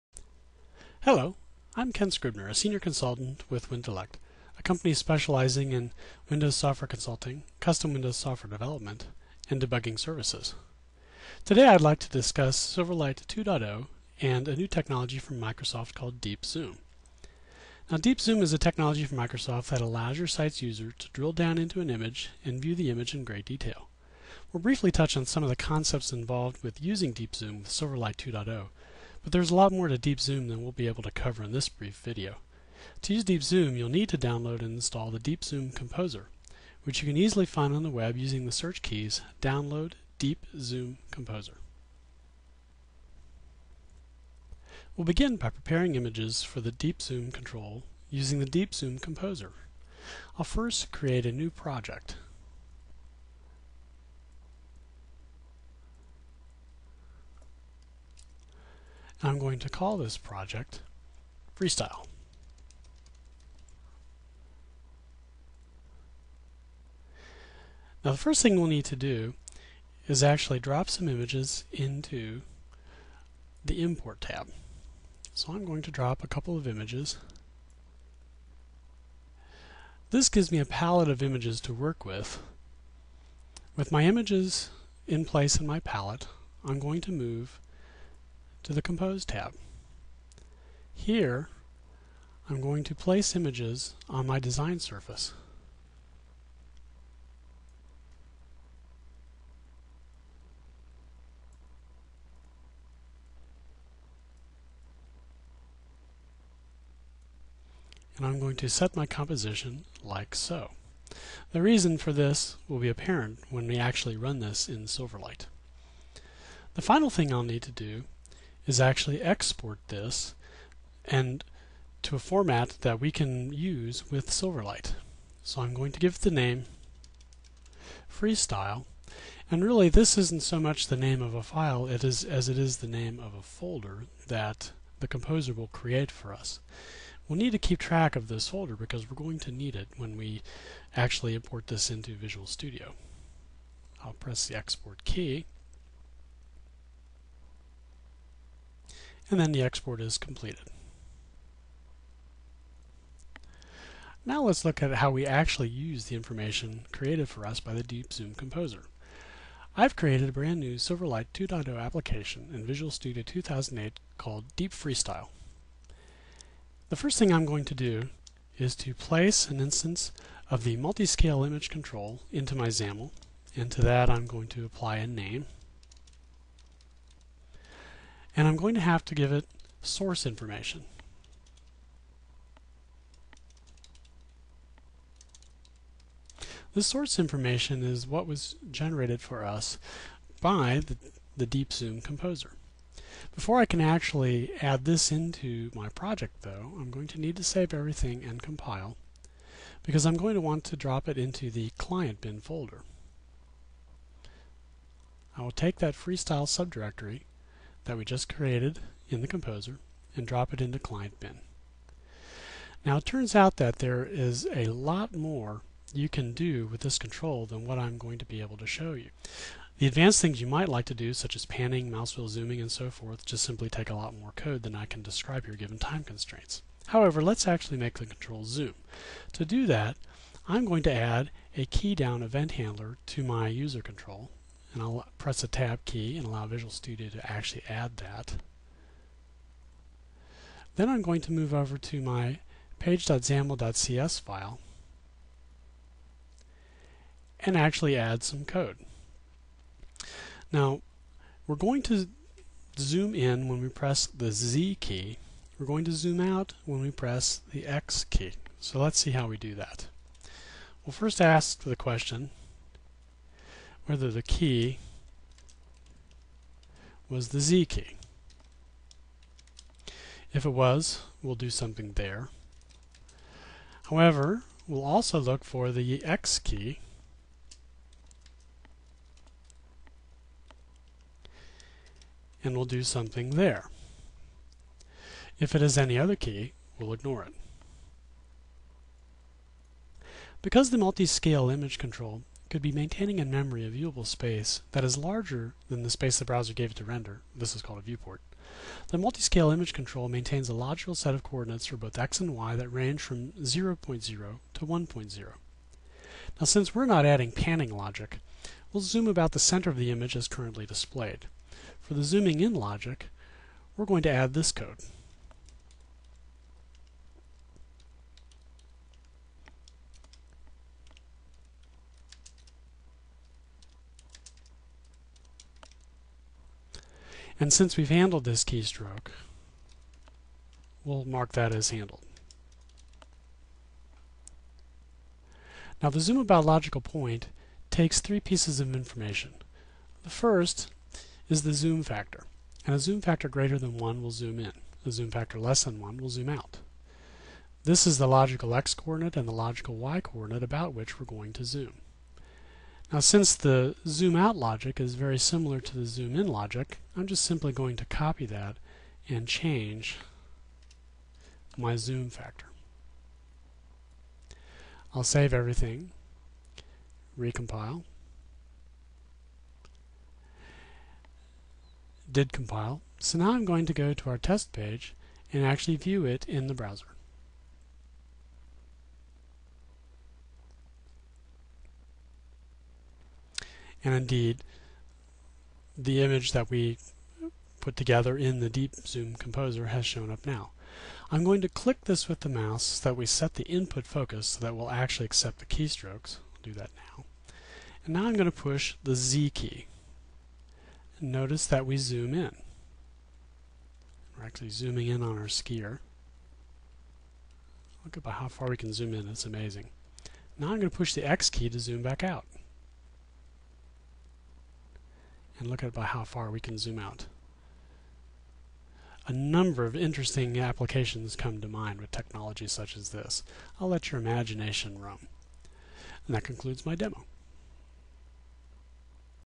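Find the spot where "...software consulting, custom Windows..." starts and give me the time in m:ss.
0:06.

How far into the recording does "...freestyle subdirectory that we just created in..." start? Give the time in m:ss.
3:25.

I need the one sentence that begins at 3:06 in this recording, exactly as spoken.
This source information is what was generated for us by the, the DeepZoom composer.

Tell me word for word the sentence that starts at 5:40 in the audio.
The first is the zoom factor, and a zoom factor greater than 1 will zoom in.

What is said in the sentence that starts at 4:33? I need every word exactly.
However, we'll also look for the X key and we'll do something there.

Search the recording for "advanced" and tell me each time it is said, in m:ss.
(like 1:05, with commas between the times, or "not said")
3:39.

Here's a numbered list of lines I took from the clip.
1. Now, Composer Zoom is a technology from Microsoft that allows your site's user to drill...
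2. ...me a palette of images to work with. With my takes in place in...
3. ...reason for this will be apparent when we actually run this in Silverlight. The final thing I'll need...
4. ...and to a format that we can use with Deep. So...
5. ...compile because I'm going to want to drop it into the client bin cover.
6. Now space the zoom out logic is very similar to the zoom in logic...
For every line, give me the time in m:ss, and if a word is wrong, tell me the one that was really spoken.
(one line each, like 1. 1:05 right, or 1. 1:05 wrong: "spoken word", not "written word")
1. 0:17 wrong: "Deep", not "Composer"
2. 1:20 wrong: "images", not "takes"
3. 1:51 right
4. 2:01 wrong: "Silverlight", not "Deep"
5. 3:18 wrong: "folder", not "cover"
6. 5:52 wrong: "since", not "space".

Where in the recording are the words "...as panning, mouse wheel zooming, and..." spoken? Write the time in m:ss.
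3:41.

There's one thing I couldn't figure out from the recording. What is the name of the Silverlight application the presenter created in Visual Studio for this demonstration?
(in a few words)
Deep Freestyle.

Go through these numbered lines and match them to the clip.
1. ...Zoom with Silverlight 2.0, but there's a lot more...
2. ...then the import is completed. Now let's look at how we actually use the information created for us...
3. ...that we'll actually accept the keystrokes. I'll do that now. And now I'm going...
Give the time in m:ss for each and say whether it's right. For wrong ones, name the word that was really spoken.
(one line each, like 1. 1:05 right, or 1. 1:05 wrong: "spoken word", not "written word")
1. 0:27 right
2. 2:29 wrong: "export", not "import"
3. 6:34 right.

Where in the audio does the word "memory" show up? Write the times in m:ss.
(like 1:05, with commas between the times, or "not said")
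4:53.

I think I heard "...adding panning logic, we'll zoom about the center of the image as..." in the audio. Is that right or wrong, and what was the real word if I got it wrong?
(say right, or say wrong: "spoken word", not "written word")
right.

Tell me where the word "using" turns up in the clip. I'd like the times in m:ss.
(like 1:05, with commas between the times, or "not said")
0:26, 0:38, 0:48.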